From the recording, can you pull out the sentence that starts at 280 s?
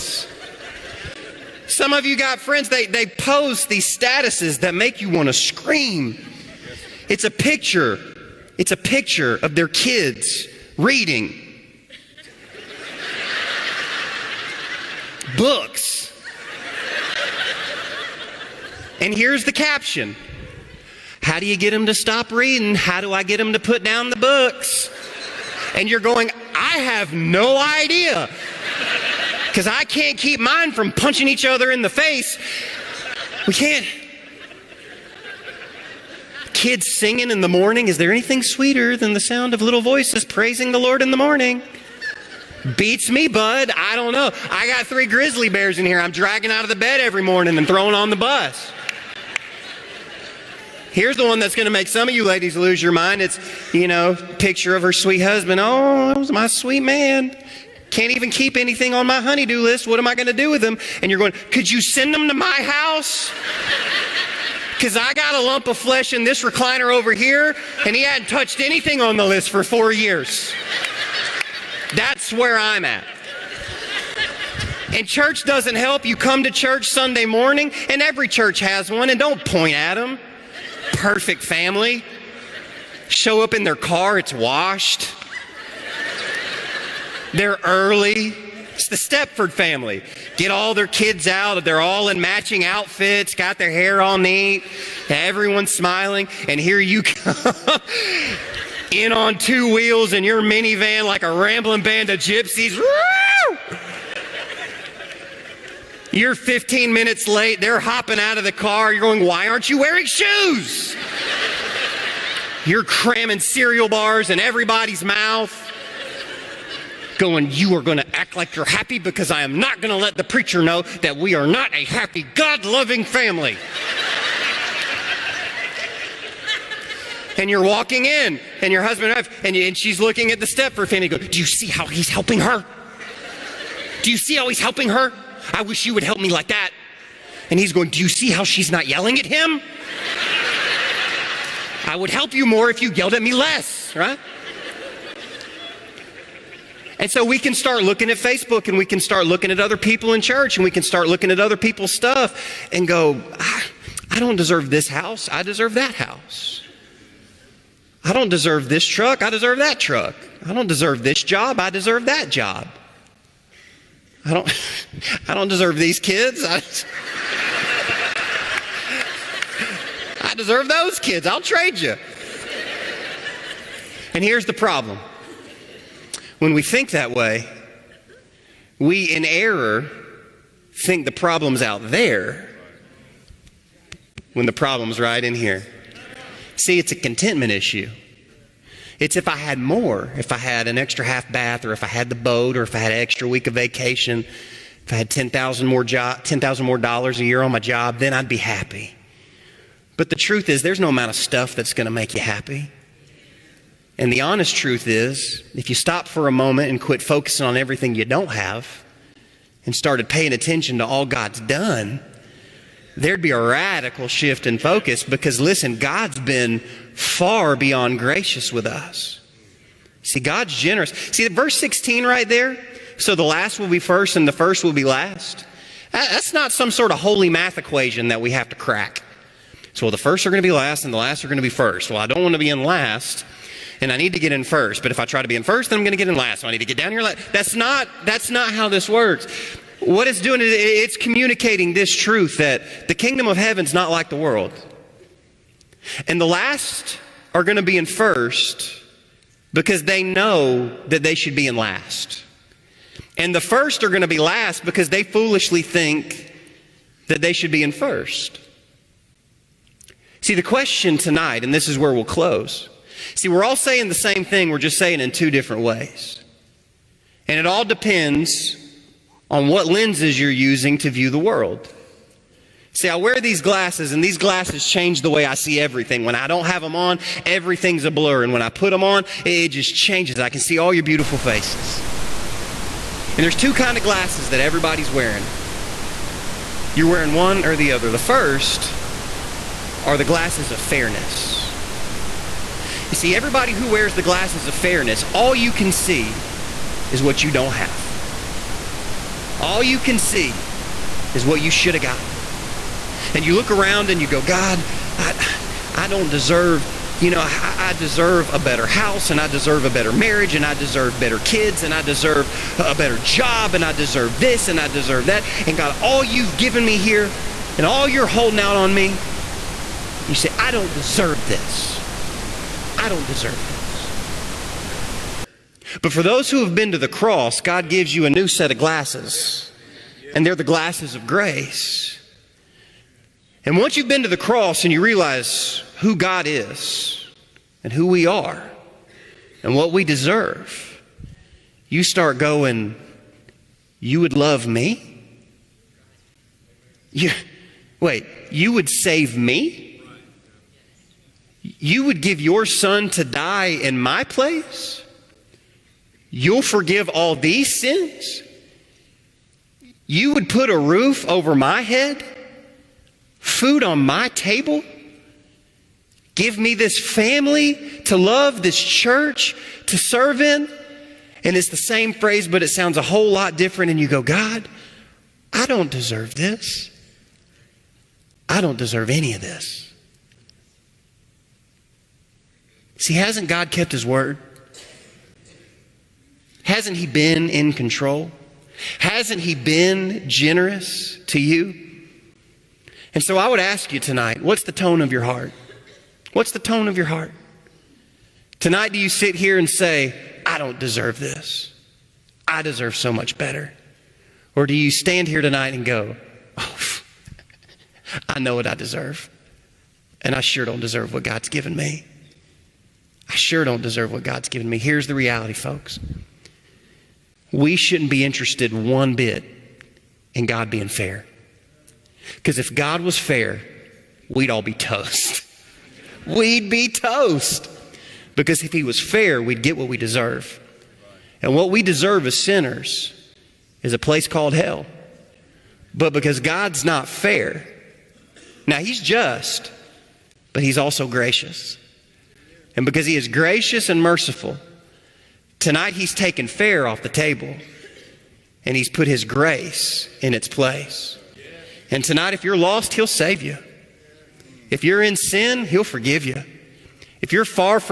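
I can see all your beautiful faces.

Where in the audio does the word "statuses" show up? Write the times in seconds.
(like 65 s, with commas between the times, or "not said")
3 s.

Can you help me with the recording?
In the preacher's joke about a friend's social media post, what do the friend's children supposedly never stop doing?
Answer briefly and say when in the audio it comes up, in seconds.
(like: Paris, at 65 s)
Reading books, at 10 s.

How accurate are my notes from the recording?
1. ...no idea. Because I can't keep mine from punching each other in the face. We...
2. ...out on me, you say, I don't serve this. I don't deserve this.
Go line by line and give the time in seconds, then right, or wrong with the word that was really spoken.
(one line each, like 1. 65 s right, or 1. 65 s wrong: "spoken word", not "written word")
1. 27 s right
2. 318 s wrong: "deserve", not "serve".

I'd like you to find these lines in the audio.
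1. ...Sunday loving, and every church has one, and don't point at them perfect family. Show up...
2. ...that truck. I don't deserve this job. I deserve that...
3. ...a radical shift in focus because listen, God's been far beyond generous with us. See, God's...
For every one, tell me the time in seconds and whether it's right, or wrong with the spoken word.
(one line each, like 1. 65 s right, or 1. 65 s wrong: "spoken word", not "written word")
1. 76 s wrong: "morning", not "loving"
2. 159 s right
3. 213 s wrong: "gracious", not "generous".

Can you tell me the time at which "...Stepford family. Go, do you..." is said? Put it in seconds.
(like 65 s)
130 s.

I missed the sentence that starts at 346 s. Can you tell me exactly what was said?
You, wait, you would save me?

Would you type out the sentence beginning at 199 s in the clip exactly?
But the truth is, there's no amount of stuff that's going to make you happy.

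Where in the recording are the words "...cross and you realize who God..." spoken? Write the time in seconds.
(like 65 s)
334 s.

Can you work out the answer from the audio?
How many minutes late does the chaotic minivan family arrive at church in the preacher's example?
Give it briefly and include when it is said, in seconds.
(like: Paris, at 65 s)
15, at 106 s.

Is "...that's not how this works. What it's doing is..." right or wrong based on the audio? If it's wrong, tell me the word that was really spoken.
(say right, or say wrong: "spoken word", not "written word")
right.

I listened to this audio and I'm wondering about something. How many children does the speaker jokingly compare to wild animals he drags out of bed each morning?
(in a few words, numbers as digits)
3.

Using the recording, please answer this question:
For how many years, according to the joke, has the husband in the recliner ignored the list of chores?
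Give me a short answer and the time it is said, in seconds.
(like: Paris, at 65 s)
4, at 69 s.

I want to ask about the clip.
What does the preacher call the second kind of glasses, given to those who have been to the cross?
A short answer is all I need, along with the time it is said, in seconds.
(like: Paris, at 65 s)
Glasses of grace, at 330 s.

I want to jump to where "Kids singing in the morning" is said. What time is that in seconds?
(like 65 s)
36 s.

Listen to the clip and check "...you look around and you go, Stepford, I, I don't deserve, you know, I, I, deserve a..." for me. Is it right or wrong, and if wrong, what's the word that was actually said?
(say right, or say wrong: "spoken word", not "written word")
wrong: "God", not "Stepford".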